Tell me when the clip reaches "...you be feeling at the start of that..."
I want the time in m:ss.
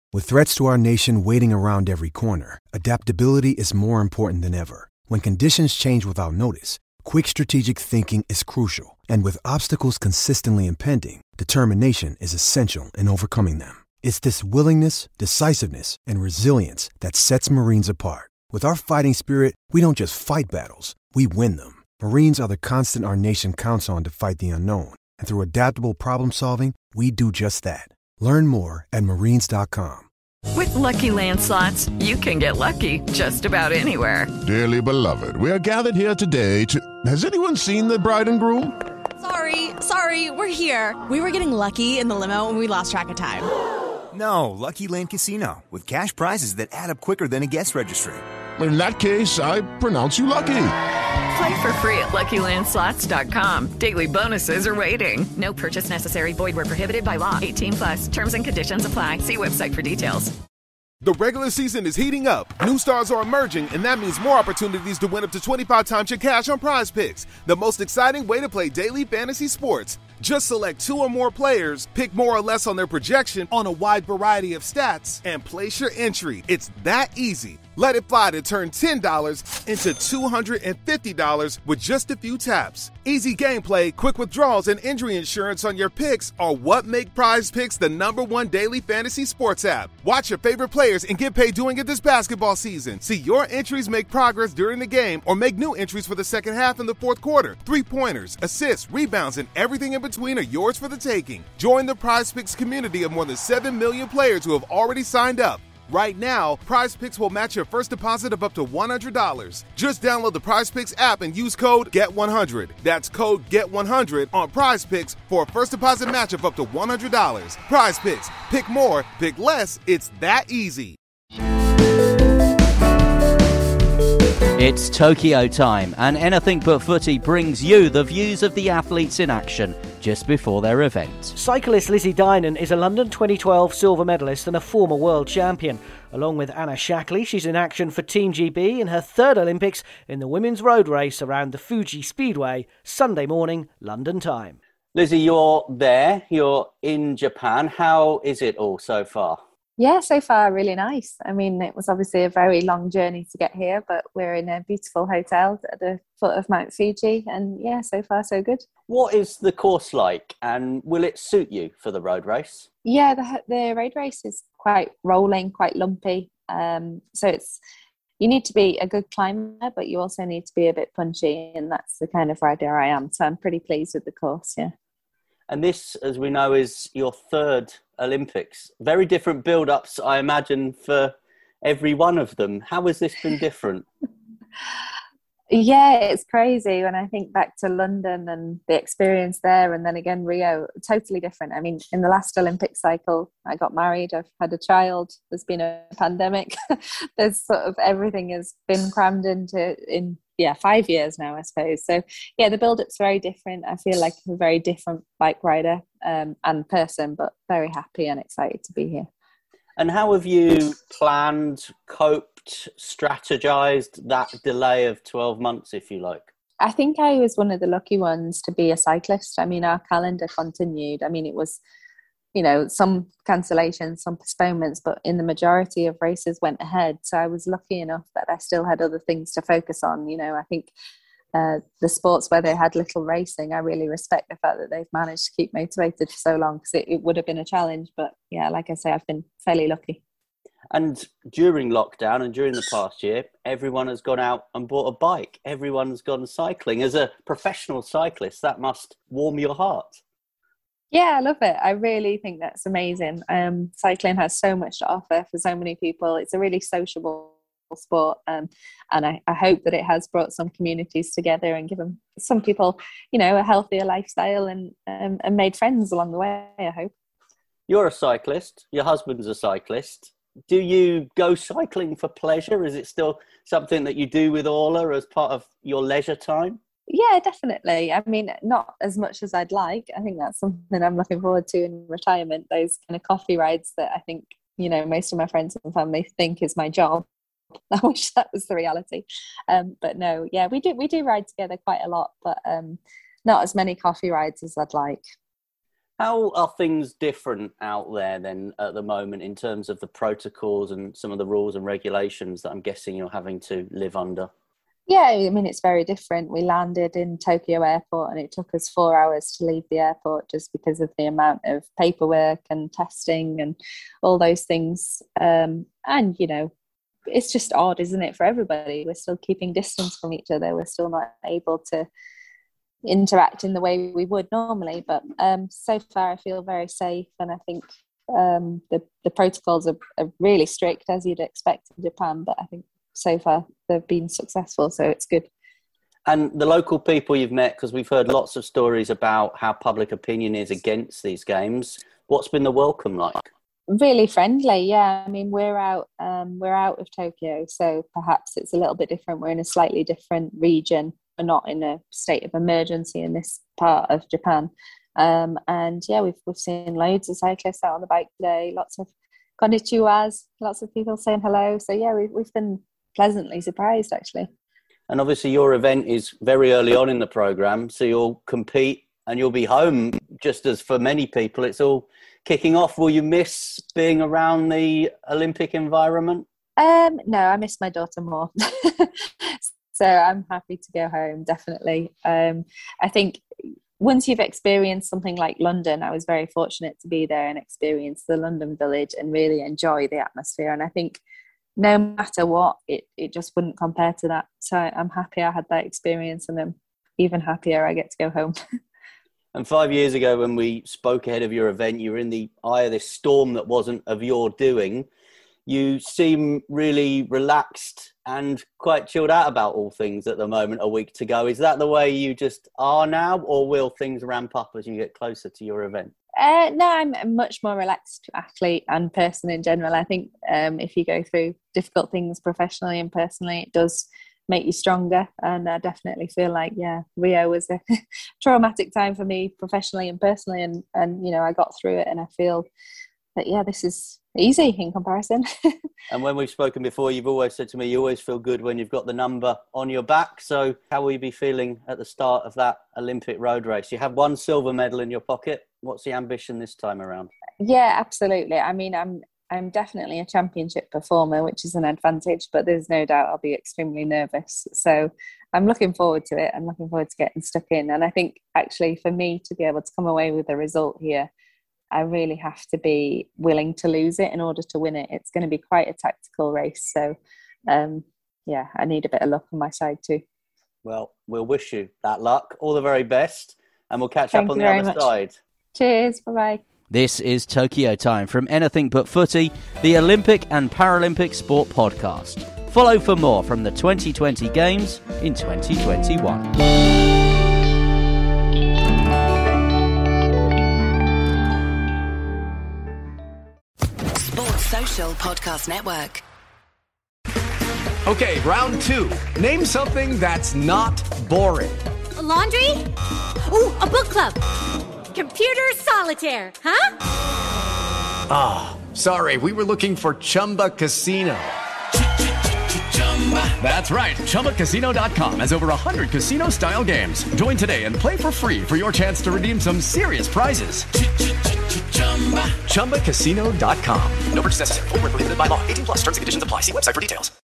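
7:20.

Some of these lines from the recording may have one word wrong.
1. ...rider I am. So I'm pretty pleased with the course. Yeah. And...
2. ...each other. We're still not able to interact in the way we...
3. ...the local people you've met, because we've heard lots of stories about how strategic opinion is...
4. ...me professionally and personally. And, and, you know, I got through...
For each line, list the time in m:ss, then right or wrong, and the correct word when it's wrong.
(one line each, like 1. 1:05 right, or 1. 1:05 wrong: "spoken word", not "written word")
1. 2:52 right
2. 5:20 right
3. 5:36 wrong: "public", not "strategic"
4. 7:09 right.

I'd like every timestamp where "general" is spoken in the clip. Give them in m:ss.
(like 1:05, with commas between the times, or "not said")
6:59.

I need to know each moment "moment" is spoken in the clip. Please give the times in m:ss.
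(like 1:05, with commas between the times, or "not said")
4:58, 6:50.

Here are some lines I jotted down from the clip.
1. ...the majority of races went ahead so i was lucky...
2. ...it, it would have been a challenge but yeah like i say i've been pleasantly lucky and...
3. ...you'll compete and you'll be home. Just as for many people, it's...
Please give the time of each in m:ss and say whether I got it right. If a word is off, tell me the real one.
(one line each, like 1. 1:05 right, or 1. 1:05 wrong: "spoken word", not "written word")
1. 3:45 right
2. 3:56 wrong: "fairly", not "pleasantly"
3. 6:07 right.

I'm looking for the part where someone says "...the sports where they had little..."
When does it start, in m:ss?
3:51.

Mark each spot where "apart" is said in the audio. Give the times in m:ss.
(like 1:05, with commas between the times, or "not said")
0:17.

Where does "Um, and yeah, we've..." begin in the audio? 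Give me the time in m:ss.
5:54.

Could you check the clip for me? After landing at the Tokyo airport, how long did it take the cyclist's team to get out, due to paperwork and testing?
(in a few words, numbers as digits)
4 hours.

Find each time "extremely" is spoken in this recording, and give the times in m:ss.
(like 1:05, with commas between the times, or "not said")
7:33.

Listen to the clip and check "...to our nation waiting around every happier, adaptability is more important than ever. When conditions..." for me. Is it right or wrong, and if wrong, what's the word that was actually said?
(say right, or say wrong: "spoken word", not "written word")
wrong: "corner", not "happier".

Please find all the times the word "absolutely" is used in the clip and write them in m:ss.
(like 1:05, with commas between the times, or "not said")
7:27.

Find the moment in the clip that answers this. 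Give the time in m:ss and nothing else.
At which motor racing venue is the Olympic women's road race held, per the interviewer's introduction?
2:21.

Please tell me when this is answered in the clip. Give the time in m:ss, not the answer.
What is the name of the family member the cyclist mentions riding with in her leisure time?
4:34.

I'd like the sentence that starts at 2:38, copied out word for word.
What is the course like, and will it suit you for the road race?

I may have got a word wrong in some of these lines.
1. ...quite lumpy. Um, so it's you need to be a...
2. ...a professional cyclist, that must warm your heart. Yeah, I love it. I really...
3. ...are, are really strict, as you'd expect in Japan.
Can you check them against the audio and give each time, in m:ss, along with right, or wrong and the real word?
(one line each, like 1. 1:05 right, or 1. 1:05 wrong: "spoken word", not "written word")
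1. 2:45 right
2. 4:06 right
3. 5:29 right.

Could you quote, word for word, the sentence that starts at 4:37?
I mean, not as much as I'd like.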